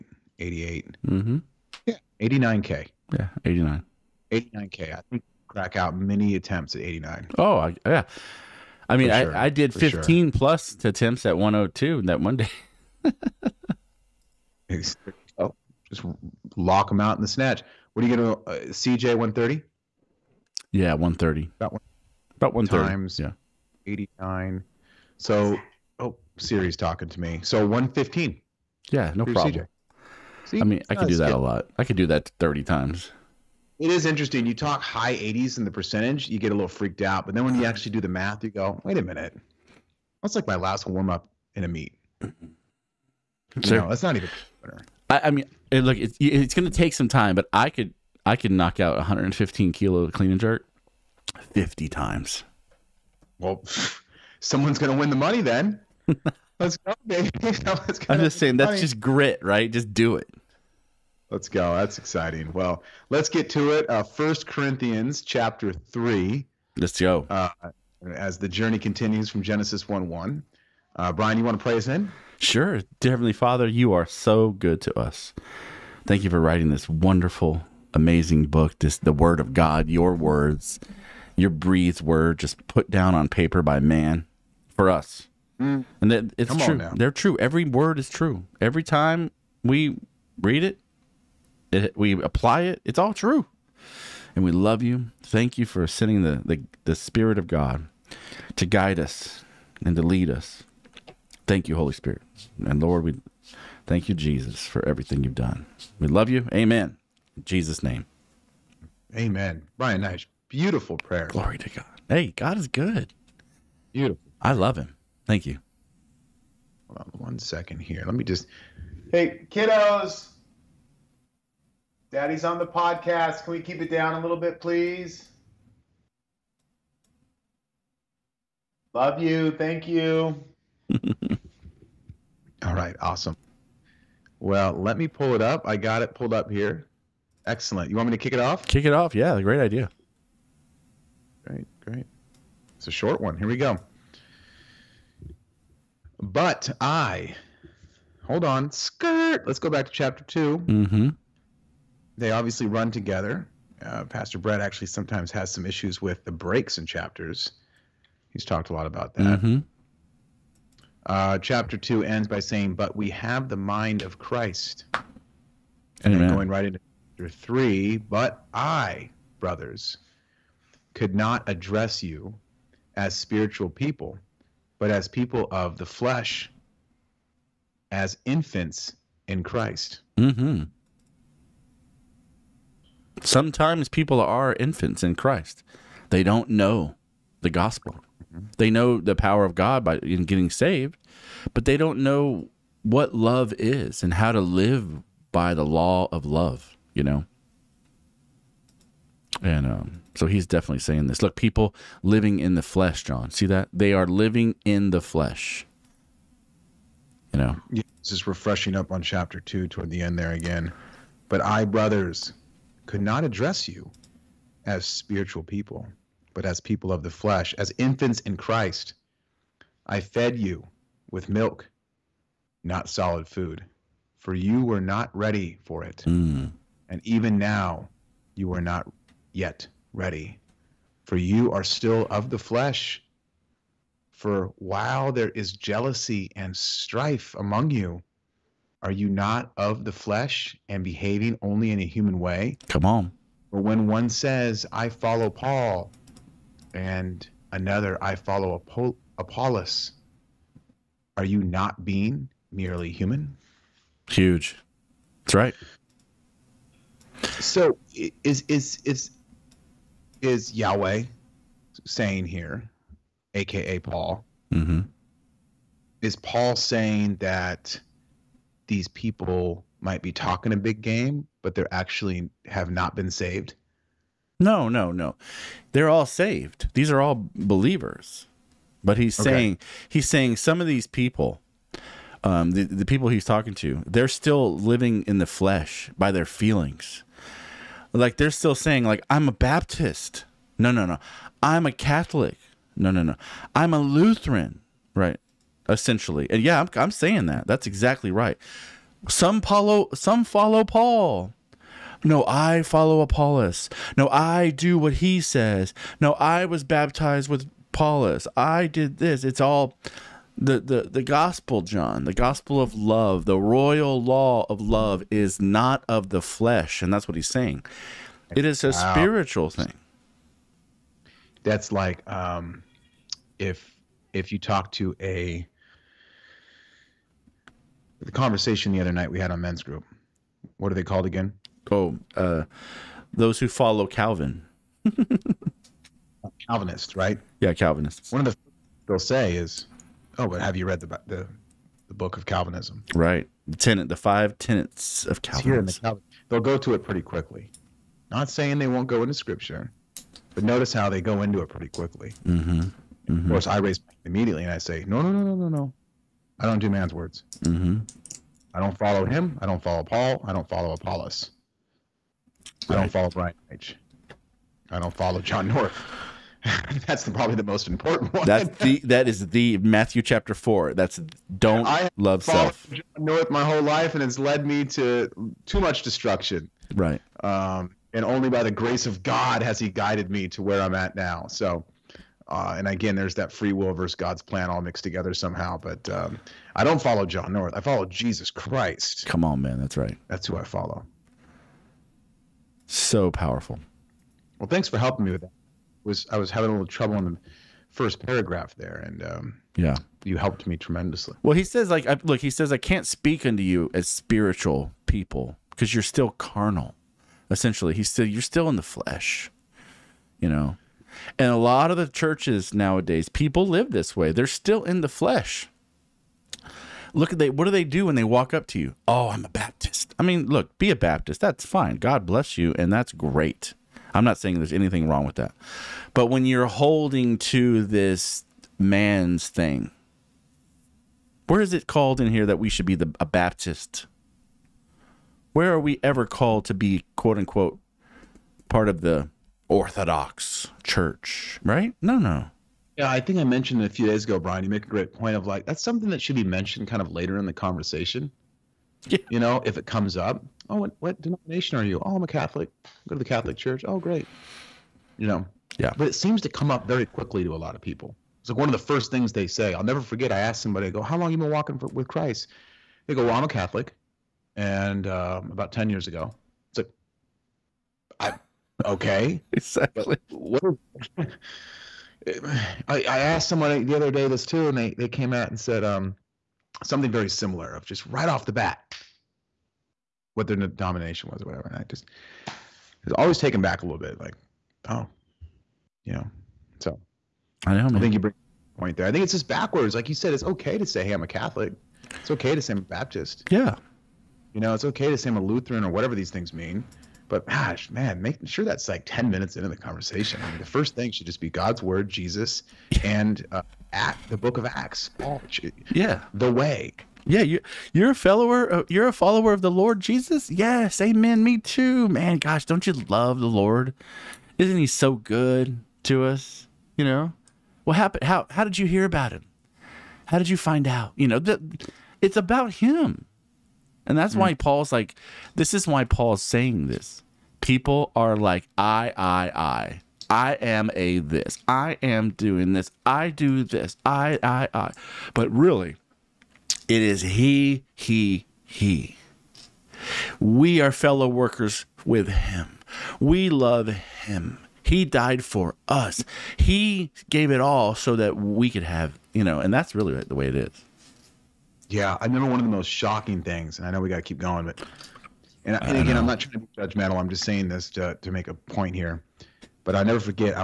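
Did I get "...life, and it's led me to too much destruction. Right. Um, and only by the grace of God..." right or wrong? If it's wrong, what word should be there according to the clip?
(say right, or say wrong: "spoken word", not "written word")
right.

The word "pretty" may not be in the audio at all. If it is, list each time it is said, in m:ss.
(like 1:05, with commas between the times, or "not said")
5:46, 5:51.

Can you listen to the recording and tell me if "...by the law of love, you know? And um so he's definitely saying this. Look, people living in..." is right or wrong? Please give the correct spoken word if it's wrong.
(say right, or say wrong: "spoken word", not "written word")
right.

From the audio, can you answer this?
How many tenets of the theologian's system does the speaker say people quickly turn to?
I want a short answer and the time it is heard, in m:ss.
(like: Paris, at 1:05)
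5, at 5:43.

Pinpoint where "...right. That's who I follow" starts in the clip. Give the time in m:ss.
6:29.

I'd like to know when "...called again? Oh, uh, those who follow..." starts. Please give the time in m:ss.
5:30.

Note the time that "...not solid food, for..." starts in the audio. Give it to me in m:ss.
3:42.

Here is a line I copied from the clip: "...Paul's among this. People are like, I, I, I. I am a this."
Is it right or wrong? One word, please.
wrong.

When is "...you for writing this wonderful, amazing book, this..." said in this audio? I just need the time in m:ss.
1:16.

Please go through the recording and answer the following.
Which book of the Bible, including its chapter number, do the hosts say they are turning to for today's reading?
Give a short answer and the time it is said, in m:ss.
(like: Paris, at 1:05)
First Corinthians chapter 3, at 1:04.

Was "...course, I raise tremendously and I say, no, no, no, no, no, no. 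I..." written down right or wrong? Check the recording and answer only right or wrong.
wrong.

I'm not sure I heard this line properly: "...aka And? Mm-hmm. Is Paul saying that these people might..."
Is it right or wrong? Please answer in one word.
wrong.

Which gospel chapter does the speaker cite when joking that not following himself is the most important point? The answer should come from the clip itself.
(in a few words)
Matthew chapter 4.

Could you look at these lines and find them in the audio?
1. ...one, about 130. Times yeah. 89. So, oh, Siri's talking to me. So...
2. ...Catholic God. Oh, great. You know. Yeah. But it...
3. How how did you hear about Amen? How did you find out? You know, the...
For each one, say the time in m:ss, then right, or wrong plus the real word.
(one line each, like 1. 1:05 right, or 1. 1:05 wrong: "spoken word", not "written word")
1. 0:21 right
2. 7:33 wrong: "Church", not "God"
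3. 8:38 wrong: "Him", not "Amen".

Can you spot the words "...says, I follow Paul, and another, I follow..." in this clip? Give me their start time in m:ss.
4:04.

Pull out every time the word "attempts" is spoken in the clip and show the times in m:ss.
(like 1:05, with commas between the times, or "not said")
0:06, 0:10.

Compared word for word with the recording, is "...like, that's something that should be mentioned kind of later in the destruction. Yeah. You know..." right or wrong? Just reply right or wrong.
wrong.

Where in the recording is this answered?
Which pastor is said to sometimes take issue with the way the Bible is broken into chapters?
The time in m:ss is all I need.
2:34.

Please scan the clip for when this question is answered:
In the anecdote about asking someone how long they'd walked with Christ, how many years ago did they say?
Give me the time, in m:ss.
7:45.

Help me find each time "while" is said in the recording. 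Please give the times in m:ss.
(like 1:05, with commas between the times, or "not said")
3:54.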